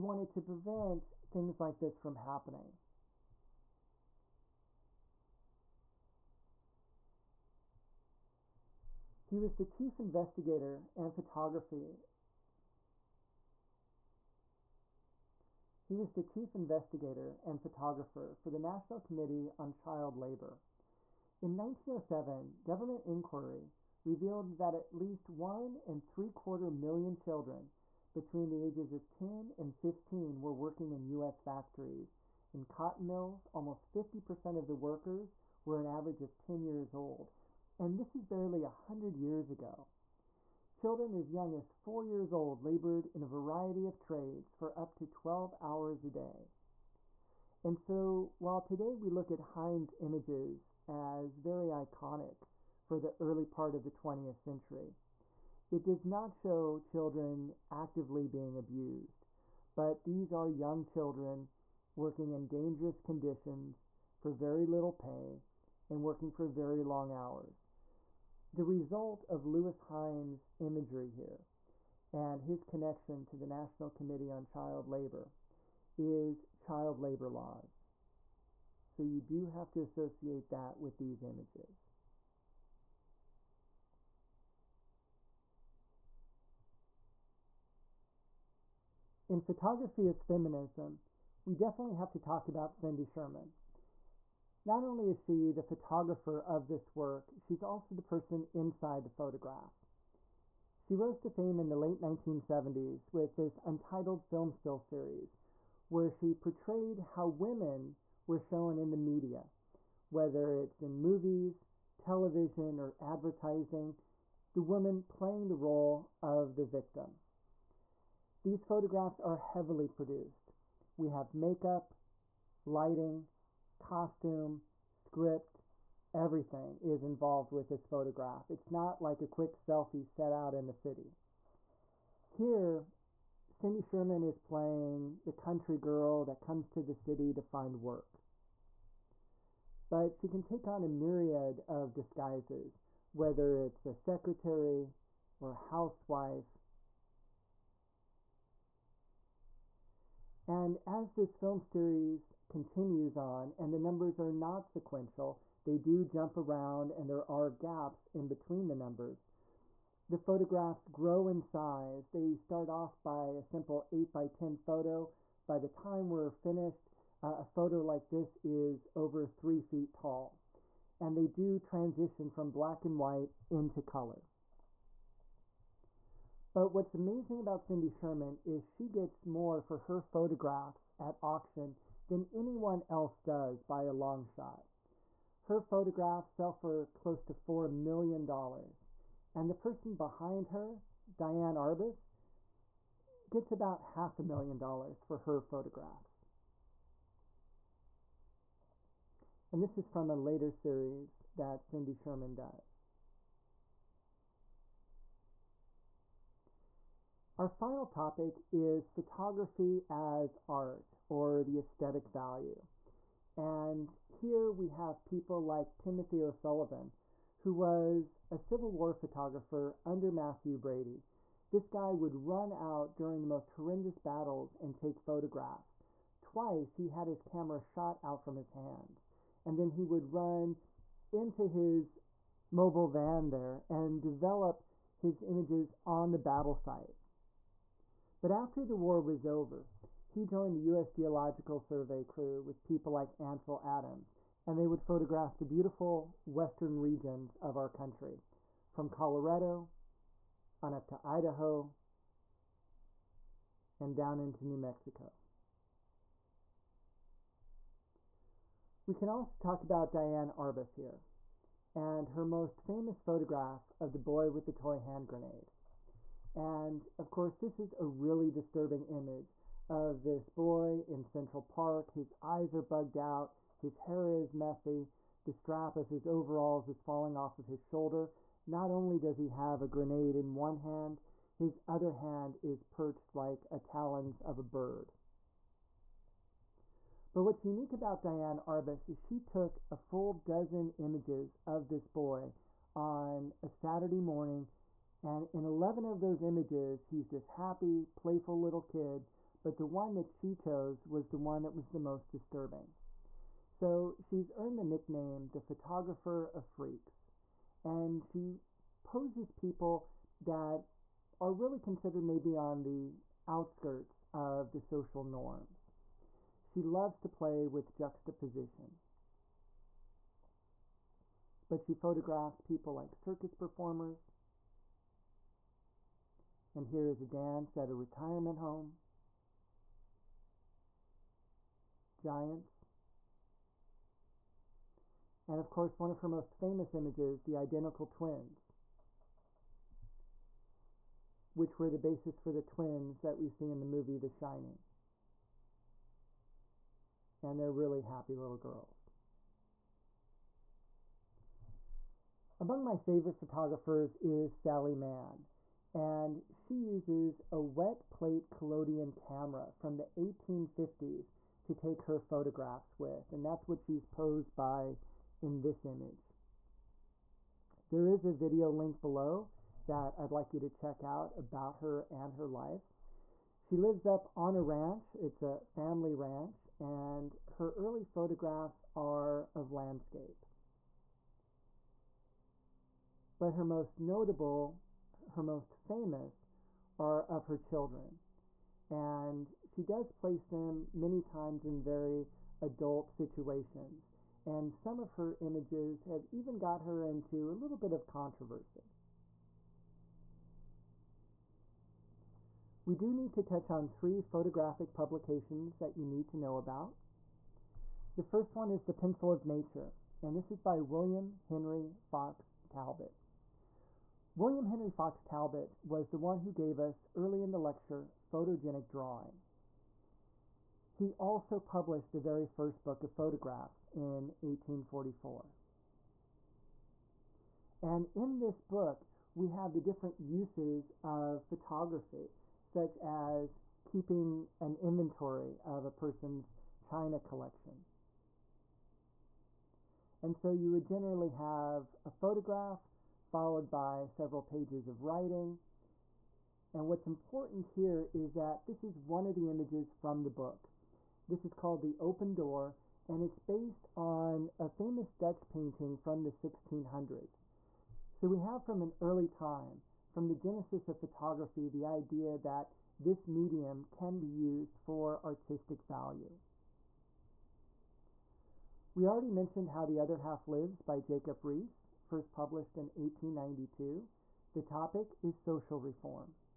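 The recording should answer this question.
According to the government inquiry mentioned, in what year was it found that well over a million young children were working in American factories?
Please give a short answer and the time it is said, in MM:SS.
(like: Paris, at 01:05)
1907, at 00:21.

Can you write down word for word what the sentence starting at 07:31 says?
This is called The Open Door, and it's based on a famous Dutch painting from the 1600s.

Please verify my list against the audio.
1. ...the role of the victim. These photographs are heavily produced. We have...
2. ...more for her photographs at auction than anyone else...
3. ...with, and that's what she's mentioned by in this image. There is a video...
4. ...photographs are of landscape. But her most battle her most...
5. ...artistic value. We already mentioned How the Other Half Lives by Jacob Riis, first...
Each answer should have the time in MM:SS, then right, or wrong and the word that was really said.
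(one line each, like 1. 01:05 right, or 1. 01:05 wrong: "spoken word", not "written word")
1. 01:55 right
2. 02:59 right
3. 06:02 wrong: "posed", not "mentioned"
4. 06:17 wrong: "notable", not "battle"
5. 07:45 right.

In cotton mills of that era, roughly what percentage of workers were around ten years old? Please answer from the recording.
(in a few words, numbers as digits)
50%.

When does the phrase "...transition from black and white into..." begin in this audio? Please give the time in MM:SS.
02:51.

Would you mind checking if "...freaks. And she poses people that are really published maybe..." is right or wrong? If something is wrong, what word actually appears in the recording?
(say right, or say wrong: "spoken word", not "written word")
wrong: "considered", not "published".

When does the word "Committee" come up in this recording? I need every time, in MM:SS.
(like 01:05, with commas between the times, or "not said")
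00:18, 01:13.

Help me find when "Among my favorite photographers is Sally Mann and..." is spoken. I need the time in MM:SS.
05:52.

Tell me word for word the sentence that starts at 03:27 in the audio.
Our final topic is photography as art or the aesthetic value.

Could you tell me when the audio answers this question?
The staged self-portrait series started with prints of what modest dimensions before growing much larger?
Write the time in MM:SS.
02:43.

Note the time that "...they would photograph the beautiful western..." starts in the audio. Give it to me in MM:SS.
04:04.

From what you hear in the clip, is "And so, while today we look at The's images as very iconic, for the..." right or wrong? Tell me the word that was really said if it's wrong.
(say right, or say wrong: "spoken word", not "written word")
wrong: "Hine", not "The".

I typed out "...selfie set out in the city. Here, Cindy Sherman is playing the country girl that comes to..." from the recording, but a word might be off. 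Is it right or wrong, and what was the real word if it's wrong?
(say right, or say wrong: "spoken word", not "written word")
right.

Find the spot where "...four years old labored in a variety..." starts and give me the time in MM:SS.
00:41.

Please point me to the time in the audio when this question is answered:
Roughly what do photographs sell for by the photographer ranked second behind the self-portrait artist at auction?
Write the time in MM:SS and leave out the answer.
03:13.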